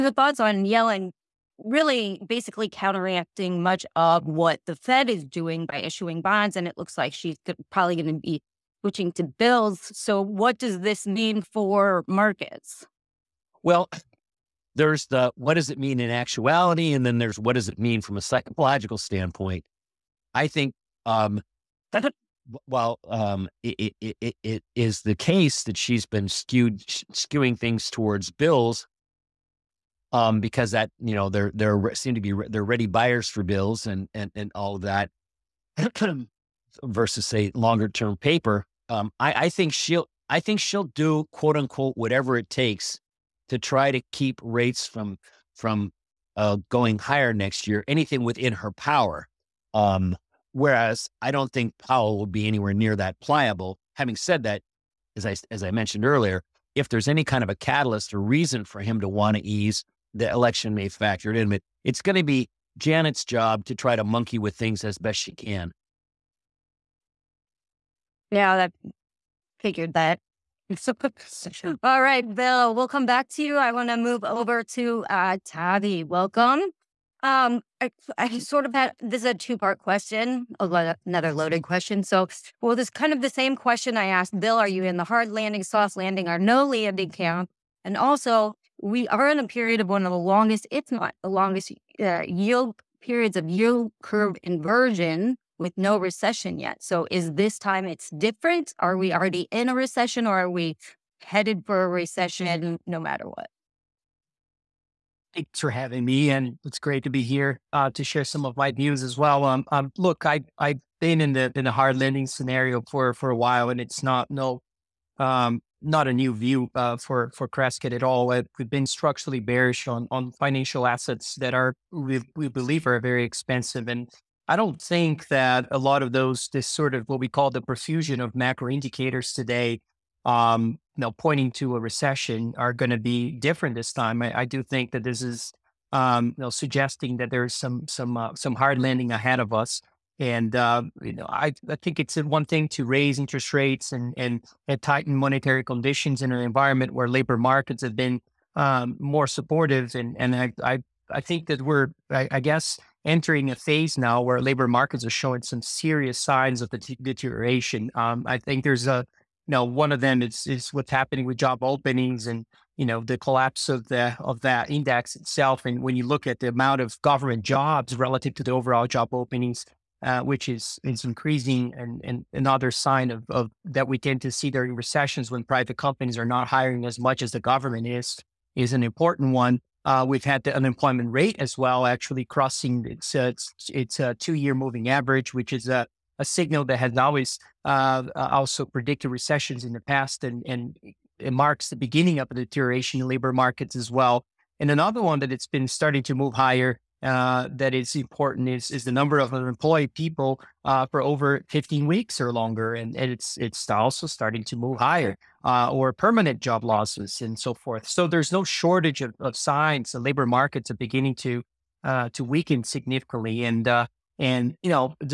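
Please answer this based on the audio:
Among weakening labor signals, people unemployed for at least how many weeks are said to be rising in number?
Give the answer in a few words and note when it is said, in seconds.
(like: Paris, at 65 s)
15, at 201 s.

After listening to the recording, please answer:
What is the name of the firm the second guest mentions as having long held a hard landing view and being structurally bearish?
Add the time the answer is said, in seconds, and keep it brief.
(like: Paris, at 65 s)
Crescat, at 117 s.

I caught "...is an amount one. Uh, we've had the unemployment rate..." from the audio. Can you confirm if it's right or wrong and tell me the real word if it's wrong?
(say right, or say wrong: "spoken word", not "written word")
wrong: "important", not "amount".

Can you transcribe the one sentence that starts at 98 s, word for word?
Are we already in a recession or are we headed for a recession no matter what?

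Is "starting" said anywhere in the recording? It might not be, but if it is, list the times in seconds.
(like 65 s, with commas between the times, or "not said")
195 s, 204 s.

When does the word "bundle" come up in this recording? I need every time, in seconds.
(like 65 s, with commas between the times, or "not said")
not said.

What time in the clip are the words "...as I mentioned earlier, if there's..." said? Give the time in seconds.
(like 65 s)
55 s.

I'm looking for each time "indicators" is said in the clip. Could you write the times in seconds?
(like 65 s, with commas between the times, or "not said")
128 s.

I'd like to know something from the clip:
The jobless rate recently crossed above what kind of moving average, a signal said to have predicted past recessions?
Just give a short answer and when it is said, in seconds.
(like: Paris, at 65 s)
Two year, at 184 s.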